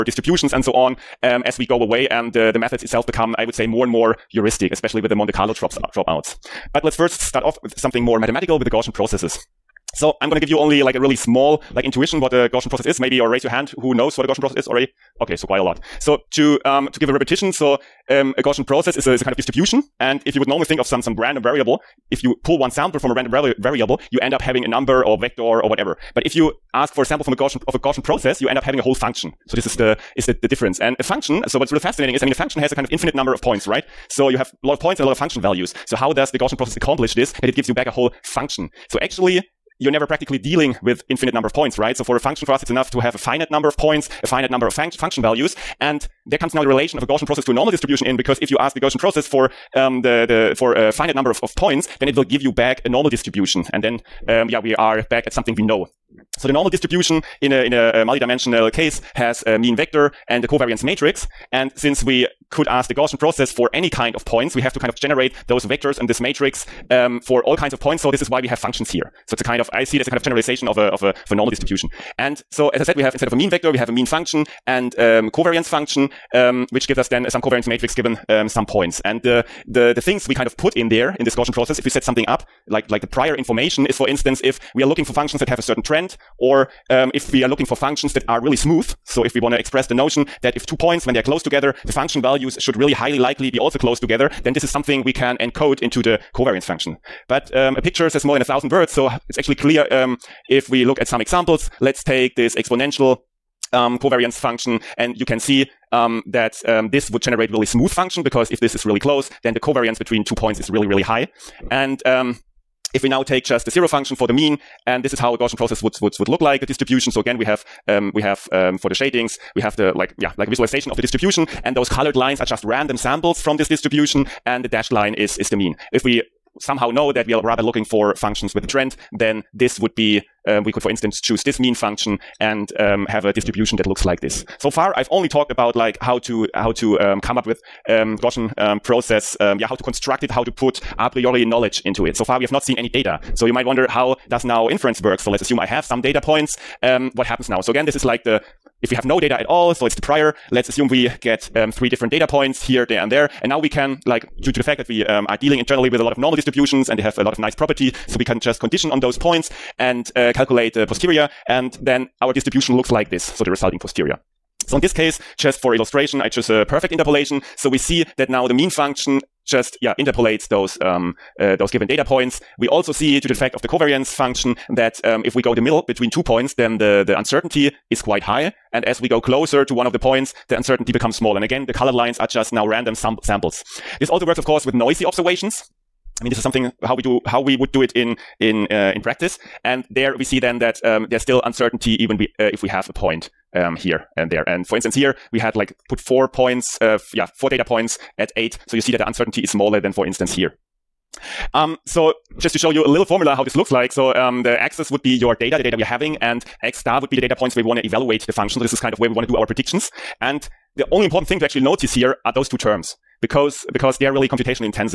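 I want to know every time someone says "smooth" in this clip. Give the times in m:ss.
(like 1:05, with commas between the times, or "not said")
1:28, 1:47.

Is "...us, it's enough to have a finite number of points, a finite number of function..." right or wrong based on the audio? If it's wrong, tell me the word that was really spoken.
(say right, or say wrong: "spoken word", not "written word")
right.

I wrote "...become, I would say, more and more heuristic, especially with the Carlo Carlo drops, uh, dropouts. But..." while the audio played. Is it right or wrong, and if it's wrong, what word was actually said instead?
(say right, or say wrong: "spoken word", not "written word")
wrong: "Monte", not "Carlo".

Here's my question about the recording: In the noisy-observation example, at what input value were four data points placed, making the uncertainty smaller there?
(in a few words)
8.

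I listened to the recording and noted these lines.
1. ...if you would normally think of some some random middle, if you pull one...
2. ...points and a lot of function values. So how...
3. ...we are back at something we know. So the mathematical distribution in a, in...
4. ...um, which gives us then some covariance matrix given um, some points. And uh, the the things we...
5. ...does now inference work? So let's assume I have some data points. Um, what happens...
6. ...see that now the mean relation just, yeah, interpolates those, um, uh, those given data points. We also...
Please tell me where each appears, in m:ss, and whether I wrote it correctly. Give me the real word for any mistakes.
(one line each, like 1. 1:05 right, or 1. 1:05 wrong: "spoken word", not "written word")
1. 0:20 wrong: "variable", not "middle"
2. 0:34 right
3. 0:54 wrong: "normal", not "mathematical"
4. 1:16 right
5. 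2:24 right
6. 2:47 wrong: "function", not "relation".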